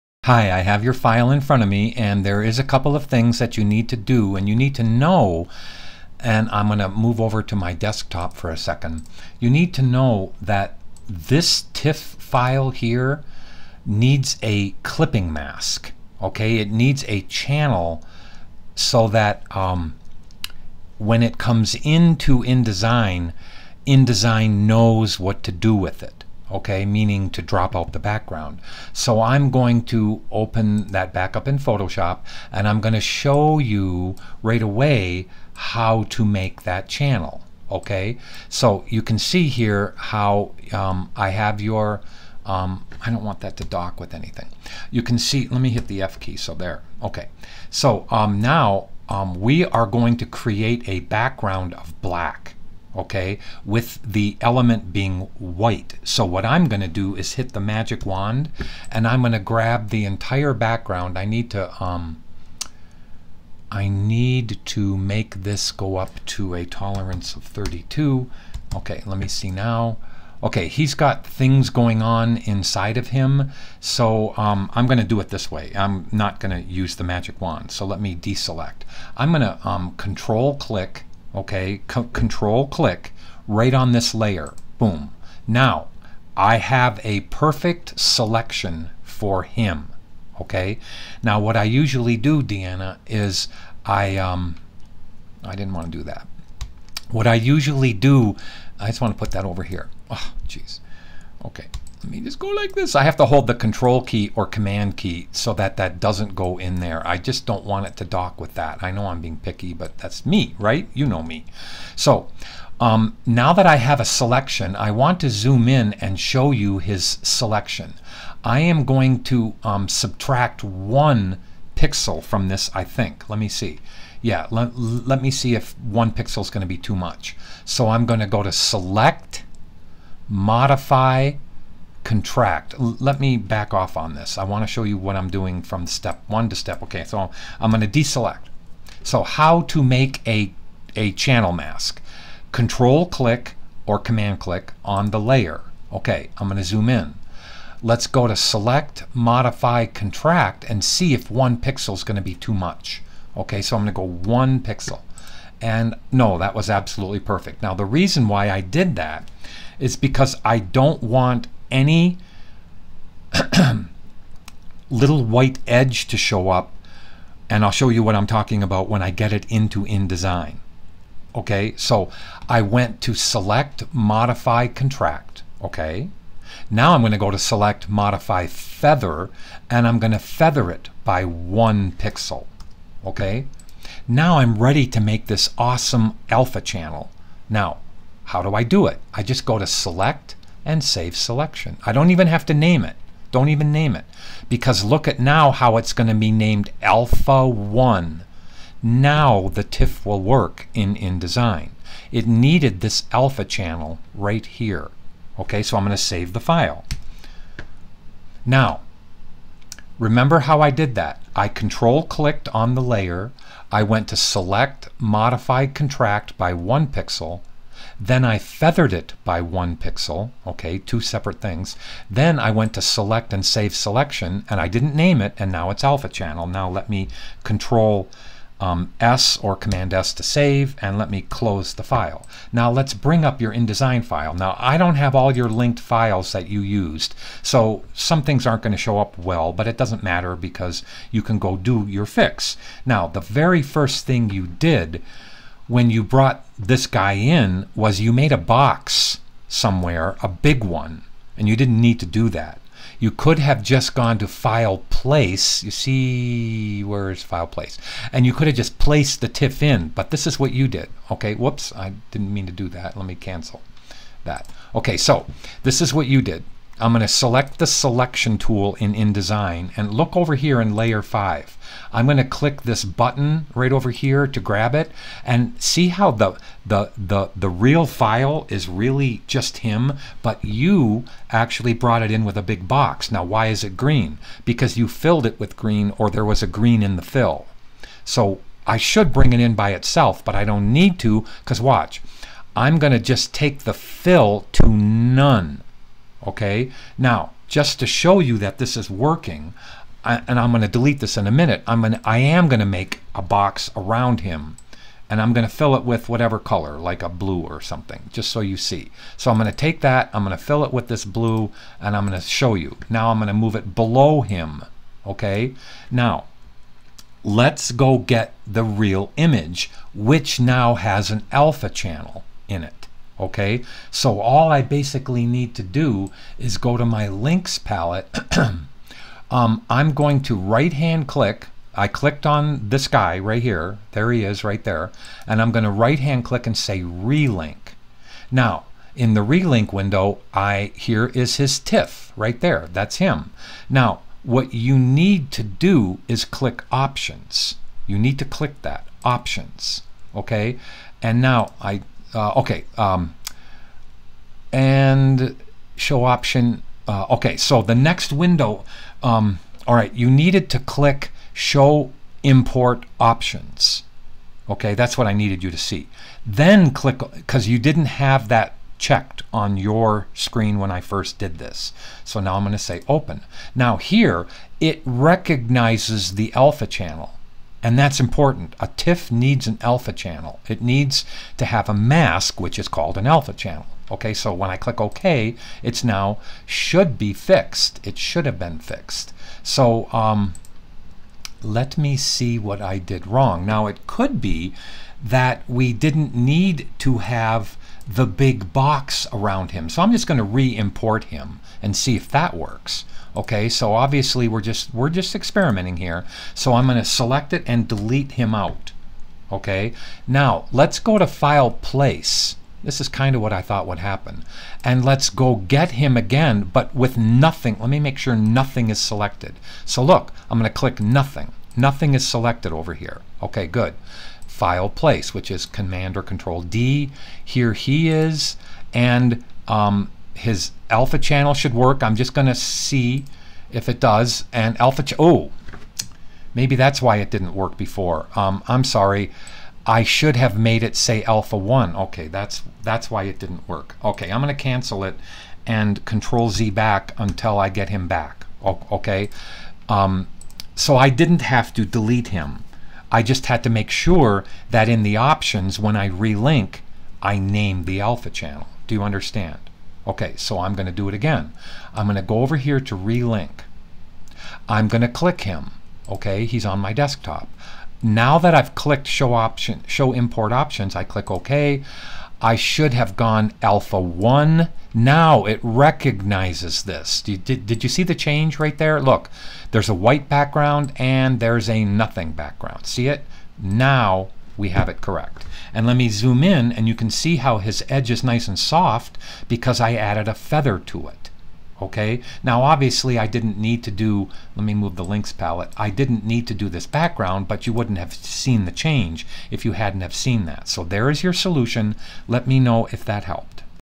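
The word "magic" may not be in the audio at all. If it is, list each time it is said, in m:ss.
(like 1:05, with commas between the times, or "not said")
0:57, 1:17.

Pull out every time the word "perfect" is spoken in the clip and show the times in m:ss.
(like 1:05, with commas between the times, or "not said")
1:27, 2:37.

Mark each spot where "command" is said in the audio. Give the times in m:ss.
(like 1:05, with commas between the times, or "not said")
1:44, 2:23, 3:49, 7:05.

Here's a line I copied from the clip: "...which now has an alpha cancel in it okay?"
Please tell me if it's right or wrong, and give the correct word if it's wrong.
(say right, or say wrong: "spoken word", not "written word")
wrong: "channel", not "cancel".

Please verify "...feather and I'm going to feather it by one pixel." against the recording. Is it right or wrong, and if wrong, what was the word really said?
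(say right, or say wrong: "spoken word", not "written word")
right.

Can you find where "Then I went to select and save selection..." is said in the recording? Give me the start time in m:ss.
3:42.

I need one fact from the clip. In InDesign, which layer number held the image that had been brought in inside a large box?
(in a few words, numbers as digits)
5.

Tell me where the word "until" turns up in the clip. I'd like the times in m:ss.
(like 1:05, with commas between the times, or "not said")
7:26.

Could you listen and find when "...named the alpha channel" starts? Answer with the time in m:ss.
7:37.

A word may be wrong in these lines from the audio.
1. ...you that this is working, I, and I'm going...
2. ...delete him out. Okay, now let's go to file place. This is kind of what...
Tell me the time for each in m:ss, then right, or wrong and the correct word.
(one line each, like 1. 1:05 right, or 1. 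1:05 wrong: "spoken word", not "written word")
1. 4:58 right
2. 6:47 right.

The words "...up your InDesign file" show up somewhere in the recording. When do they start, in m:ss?
3:53.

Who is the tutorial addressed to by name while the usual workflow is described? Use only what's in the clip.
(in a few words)
Deanna.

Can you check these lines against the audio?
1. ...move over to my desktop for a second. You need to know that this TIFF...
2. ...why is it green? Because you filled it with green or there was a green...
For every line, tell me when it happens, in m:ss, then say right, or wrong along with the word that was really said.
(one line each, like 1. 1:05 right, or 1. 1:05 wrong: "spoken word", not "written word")
1. 0:06 right
2. 4:43 right.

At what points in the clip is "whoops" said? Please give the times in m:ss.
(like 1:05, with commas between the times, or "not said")
4:21.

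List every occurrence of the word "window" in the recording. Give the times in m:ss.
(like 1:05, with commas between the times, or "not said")
5:39, 5:58.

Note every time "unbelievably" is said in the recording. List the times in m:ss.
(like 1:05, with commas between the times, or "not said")
not said.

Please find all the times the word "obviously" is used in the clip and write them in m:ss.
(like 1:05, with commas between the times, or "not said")
6:43, 8:12.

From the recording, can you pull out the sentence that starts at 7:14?
And alpha, oh, maybe that's why it didn't work before.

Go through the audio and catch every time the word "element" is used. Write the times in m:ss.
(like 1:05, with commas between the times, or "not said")
0:54.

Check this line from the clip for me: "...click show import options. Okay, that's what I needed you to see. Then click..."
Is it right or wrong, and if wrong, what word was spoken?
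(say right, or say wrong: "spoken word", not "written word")
right.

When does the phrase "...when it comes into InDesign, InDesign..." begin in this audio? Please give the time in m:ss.
0:20.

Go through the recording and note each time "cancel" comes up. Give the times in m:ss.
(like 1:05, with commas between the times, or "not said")
4:23, 7:24.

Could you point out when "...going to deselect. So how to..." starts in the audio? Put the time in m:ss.
2:17.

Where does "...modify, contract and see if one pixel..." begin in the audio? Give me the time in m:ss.
2:29.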